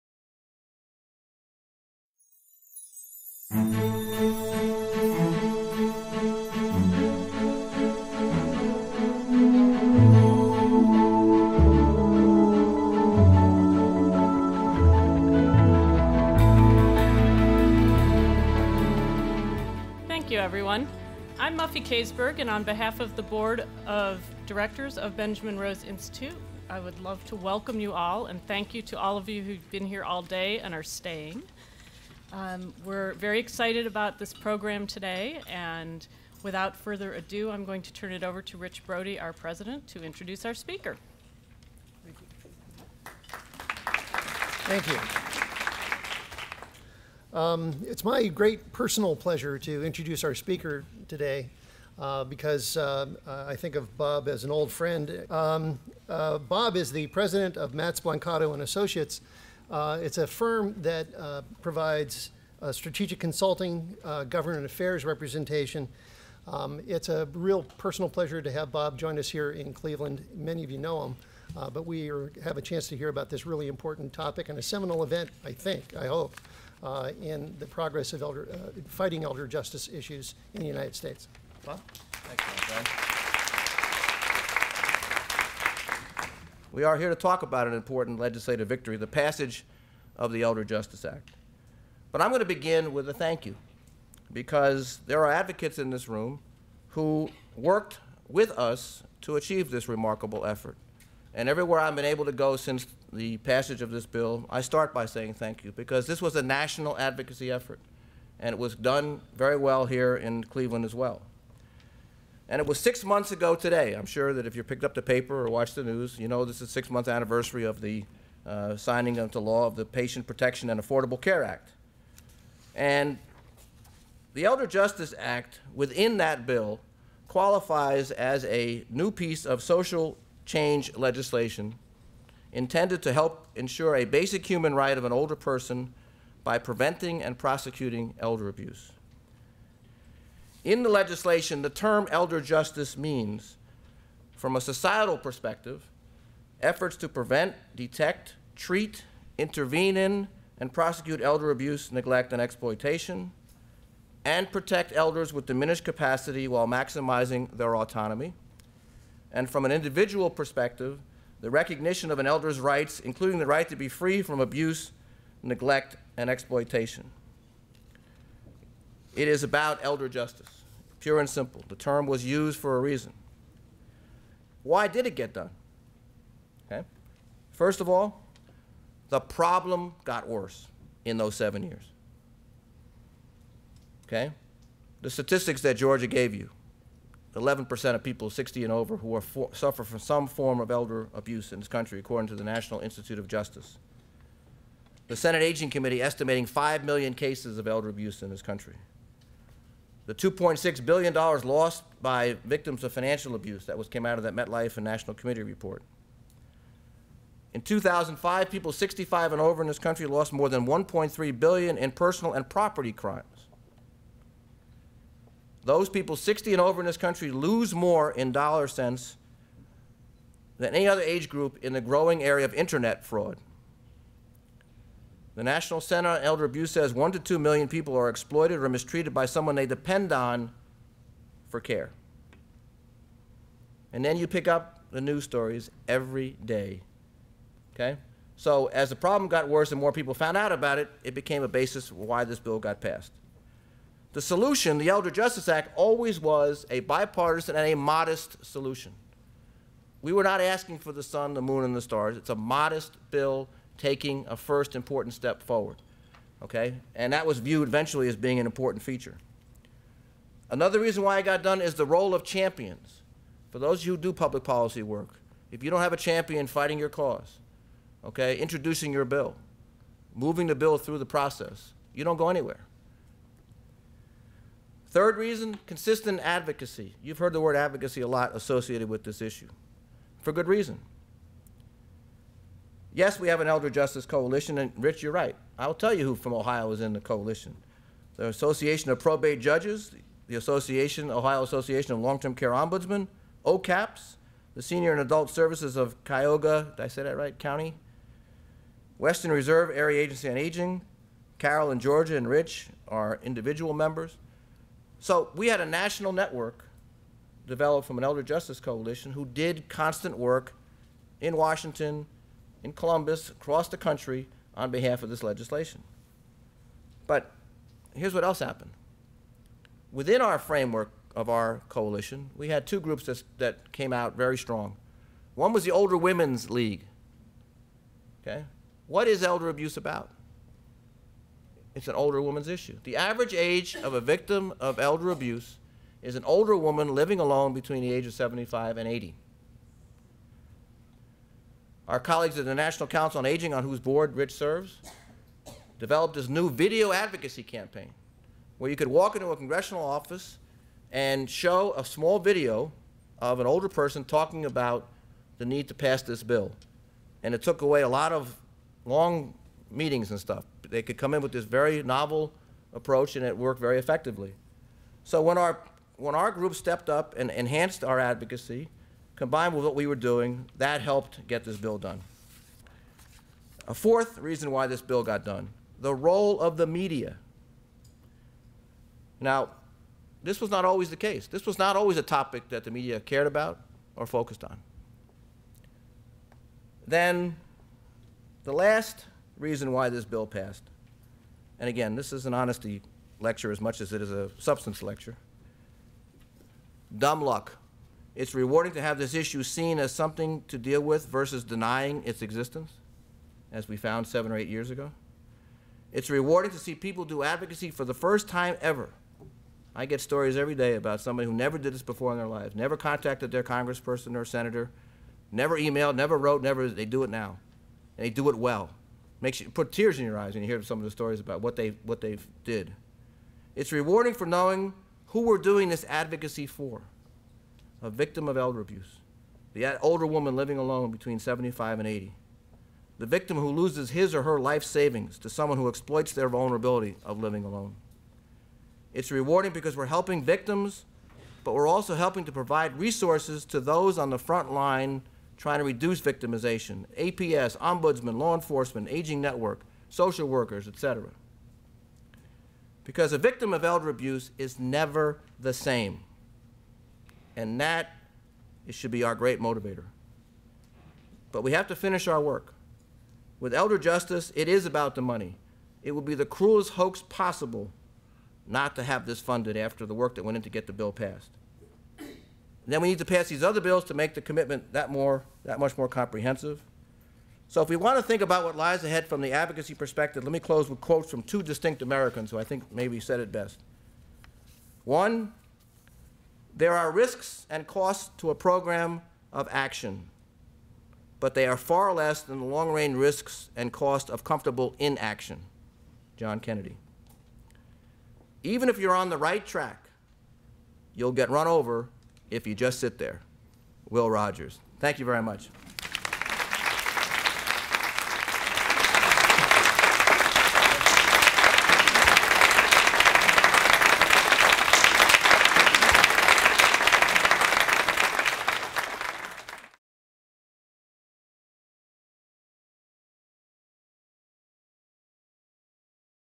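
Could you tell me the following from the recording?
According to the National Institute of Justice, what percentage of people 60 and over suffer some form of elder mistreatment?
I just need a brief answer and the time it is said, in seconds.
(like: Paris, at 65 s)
11%, at 187 s.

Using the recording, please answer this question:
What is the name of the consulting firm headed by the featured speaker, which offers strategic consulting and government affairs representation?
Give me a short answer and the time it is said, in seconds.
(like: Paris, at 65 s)
Matz Blancato and Associates, at 57 s.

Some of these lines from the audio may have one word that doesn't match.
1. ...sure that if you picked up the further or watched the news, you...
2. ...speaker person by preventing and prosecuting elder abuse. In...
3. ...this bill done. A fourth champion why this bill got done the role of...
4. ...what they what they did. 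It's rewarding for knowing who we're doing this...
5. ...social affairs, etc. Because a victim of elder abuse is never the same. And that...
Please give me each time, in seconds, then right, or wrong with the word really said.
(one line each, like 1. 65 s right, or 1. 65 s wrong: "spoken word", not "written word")
1. 114 s wrong: "paper", not "further"
2. 135 s wrong: "older", not "speaker"
3. 371 s wrong: "reason", not "champion"
4. 421 s right
5. 449 s wrong: "workers", not "affairs".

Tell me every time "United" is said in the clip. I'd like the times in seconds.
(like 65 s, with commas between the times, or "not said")
80 s.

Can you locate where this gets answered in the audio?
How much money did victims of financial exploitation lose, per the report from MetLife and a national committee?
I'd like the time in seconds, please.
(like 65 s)
200 s.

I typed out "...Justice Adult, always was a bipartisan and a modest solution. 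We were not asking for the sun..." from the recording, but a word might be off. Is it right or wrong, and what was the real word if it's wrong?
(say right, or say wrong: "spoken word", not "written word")
wrong: "Act", not "Adult".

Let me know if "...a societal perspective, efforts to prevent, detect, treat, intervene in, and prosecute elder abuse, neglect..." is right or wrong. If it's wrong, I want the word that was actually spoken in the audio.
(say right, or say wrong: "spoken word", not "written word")
right.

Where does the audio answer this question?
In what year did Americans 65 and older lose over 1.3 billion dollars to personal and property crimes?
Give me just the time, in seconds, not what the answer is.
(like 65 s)
207 s.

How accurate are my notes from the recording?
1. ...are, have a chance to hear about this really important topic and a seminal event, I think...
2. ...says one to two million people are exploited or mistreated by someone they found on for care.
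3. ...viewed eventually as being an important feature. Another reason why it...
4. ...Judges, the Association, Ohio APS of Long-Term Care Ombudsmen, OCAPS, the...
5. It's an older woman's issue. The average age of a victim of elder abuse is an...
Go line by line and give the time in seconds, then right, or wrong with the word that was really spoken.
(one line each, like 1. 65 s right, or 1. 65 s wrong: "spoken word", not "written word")
1. 72 s right
2. 226 s wrong: "depend", not "found"
3. 257 s right
4. 289 s wrong: "Association", not "APS"
5. 331 s right.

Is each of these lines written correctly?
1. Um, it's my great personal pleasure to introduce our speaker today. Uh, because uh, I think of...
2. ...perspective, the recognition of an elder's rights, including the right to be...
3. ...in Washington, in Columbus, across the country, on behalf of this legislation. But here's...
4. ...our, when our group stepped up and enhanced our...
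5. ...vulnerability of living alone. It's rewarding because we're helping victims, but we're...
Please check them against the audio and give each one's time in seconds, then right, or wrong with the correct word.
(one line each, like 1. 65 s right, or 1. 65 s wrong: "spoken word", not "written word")
1. 47 s right
2. 160 s right
3. 311 s right
4. 365 s right
5. 436 s right.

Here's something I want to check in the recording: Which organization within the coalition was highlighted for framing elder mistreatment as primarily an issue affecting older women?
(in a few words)
Older Women's League.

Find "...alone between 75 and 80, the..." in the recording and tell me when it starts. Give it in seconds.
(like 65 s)
430 s.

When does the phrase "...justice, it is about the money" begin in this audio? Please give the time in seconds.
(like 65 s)
463 s.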